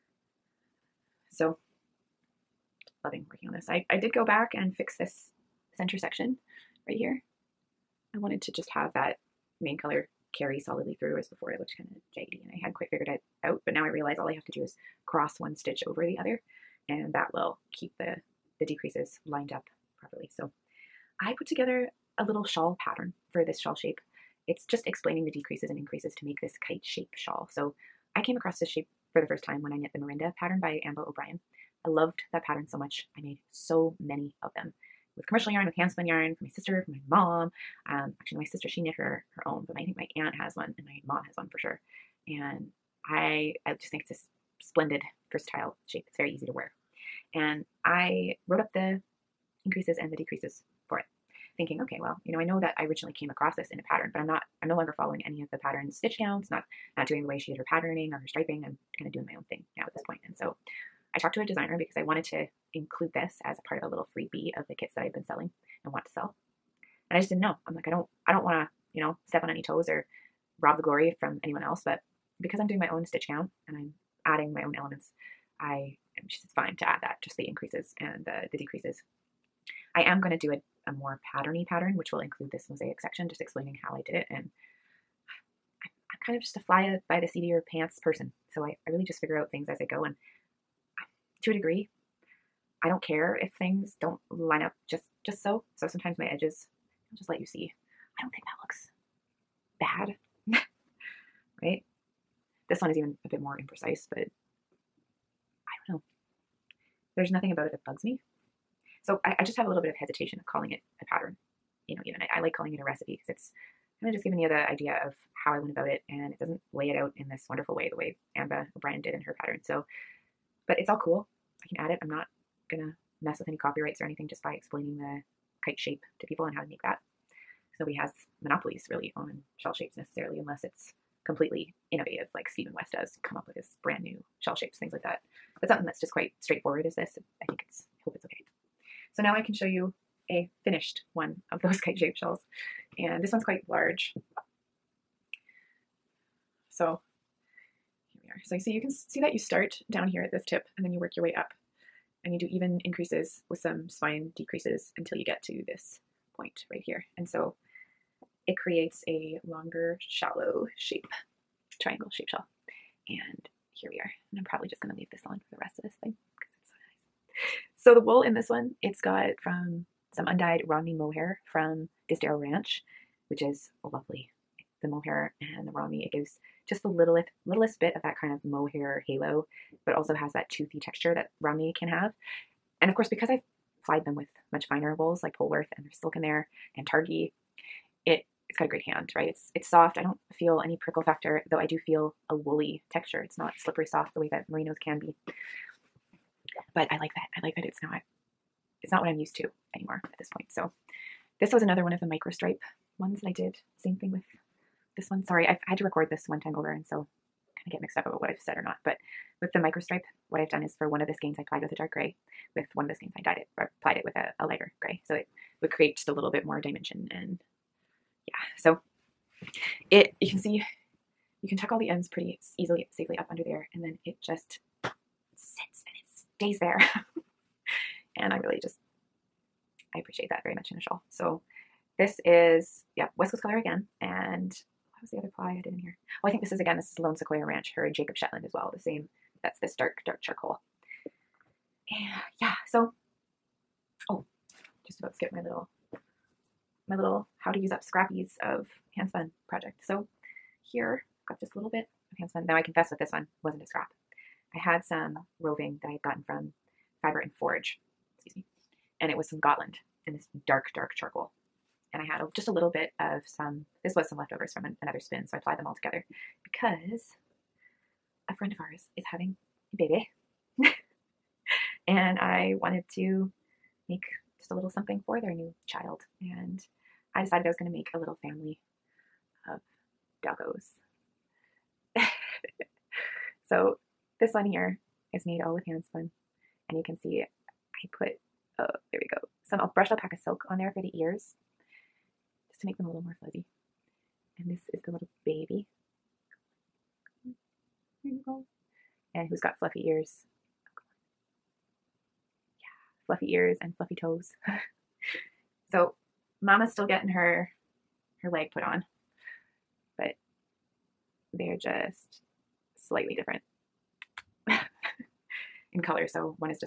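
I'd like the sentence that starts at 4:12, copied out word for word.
Now I confess with this one, wasn't a scrap.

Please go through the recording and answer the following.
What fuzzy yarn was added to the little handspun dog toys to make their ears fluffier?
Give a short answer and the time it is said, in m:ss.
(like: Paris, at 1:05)
brushed alpaca silk, at 4:49.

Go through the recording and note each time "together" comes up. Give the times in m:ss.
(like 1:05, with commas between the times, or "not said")
0:21, 4:25.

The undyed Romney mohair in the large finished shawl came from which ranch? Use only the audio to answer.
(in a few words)
Disdero Ranch.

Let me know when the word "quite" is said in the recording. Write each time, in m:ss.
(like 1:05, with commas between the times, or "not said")
0:12, 2:16, 2:23.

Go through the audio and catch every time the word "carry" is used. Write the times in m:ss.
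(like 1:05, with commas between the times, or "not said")
0:10.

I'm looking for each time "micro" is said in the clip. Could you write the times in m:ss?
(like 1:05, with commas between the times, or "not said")
3:22, 3:29.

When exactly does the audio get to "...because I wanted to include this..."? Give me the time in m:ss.
1:01.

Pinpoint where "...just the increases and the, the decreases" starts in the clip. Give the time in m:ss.
1:17.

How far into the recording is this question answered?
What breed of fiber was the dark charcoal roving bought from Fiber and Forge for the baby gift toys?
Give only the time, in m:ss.
4:19.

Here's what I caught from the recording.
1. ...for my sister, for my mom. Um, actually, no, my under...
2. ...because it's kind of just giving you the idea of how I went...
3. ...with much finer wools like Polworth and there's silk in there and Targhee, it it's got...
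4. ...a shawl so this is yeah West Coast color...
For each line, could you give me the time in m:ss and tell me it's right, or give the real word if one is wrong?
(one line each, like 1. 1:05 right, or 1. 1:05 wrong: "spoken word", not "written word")
1. 0:36 wrong: "sister", not "under"
2. 1:53 right
3. 3:04 right
4. 3:50 right.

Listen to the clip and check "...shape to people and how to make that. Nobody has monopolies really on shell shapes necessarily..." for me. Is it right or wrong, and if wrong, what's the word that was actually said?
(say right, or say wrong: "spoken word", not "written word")
right.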